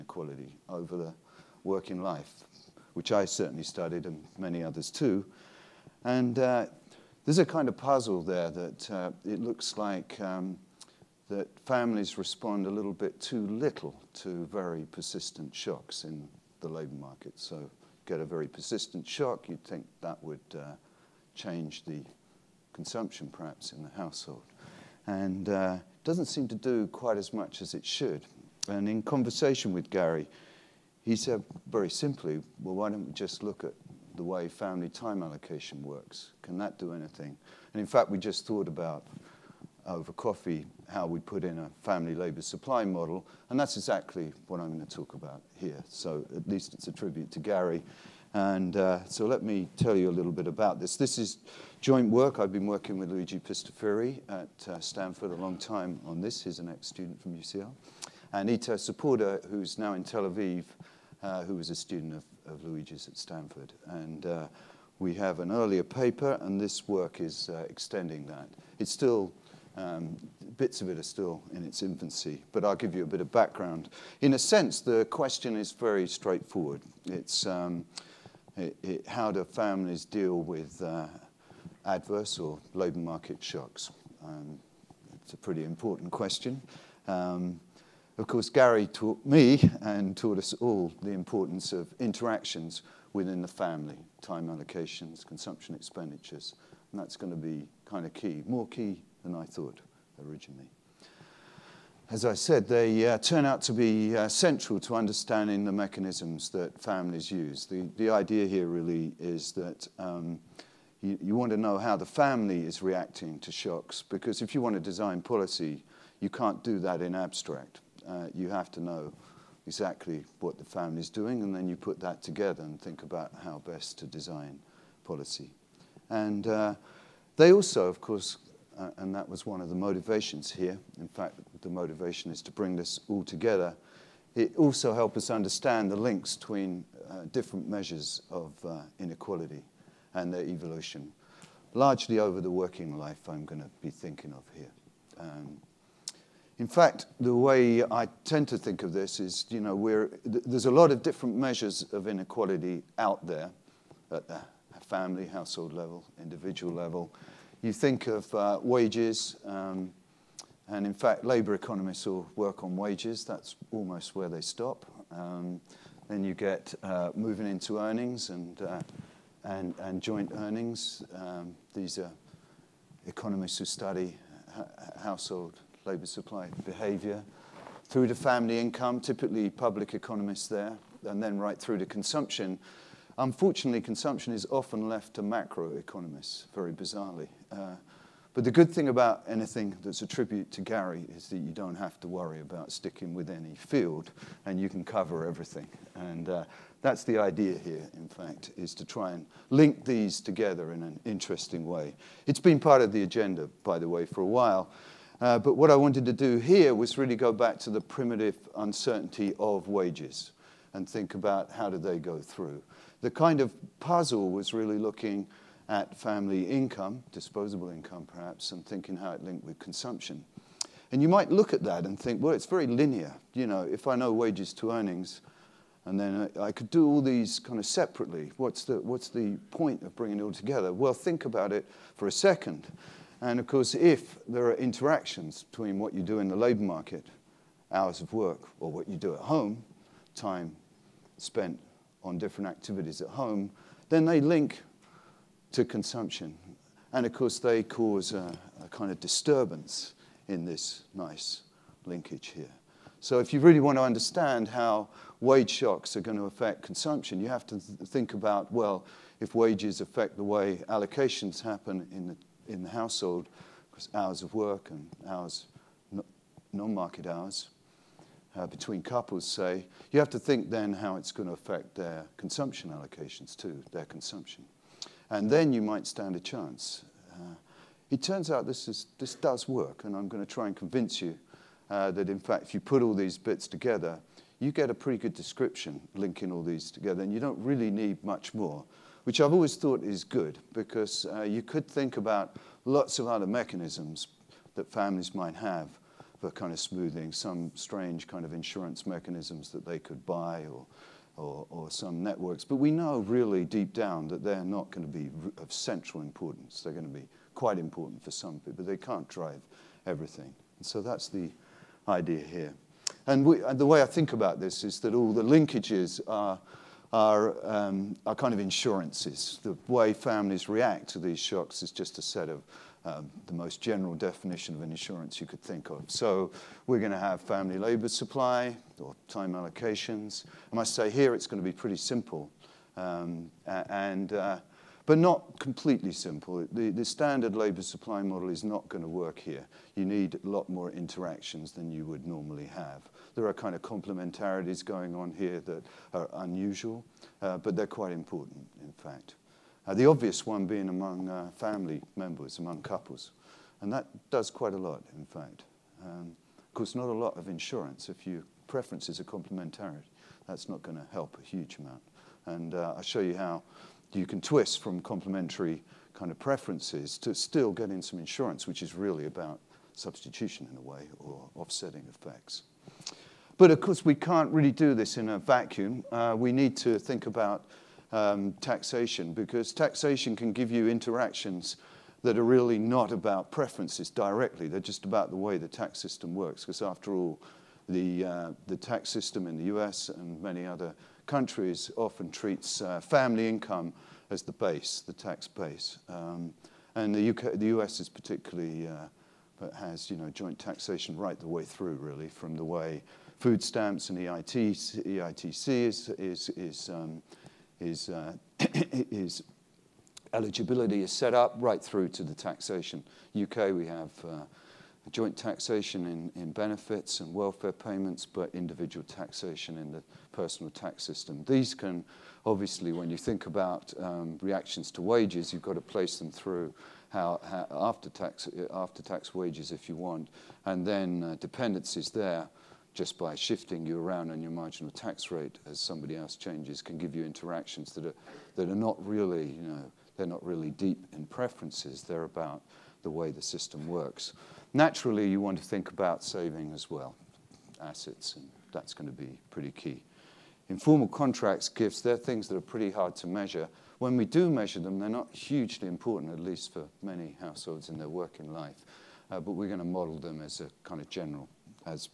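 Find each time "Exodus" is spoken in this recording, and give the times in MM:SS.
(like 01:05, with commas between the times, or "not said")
not said.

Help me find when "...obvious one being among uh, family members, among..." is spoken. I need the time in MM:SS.
05:49.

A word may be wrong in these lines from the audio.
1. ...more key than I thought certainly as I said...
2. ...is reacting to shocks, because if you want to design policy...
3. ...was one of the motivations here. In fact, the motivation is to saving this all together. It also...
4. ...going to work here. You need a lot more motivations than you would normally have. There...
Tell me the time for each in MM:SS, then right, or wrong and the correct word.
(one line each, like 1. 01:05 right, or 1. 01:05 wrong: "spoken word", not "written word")
1. 01:38 wrong: "originally", not "certainly"
2. 01:52 right
3. 02:09 wrong: "bring", not "saving"
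4. 05:38 wrong: "interactions", not "motivations".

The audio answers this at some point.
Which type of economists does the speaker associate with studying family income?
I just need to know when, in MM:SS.
02:59.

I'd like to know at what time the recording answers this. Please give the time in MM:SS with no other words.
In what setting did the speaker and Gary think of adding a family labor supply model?
00:39.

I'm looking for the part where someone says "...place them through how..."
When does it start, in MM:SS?
07:05.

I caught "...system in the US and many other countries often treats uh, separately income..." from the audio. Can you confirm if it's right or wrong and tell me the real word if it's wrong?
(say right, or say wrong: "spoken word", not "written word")
wrong: "family", not "separately".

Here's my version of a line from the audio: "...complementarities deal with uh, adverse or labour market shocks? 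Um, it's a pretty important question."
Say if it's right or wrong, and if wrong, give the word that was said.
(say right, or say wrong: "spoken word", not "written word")
wrong: "families", not "complementarities".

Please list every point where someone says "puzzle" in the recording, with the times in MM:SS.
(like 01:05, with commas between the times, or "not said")
00:07, 03:33.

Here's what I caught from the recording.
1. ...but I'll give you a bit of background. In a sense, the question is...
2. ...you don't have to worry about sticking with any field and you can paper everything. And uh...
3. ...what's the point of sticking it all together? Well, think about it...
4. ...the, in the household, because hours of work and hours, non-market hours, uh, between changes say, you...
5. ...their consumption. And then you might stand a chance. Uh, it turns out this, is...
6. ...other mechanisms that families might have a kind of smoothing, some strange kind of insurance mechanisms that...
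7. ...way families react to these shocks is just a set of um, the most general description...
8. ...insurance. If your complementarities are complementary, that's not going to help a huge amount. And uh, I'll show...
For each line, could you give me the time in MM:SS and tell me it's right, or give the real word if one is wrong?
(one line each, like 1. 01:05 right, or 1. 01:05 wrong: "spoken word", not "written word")
1. 01:12 right
2. 03:11 wrong: "cover", not "paper"
3. 03:48 wrong: "bringing", not "sticking"
4. 04:22 wrong: "couples", not "changes"
5. 04:33 right
6. 04:53 right
7. 05:19 wrong: "definition", not "description"
8. 05:57 wrong: "preferences", not "complementarities".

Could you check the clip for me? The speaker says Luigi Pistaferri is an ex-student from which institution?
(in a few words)
UCL.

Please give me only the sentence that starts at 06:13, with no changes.
But of course, we can't really do this in a vacuum.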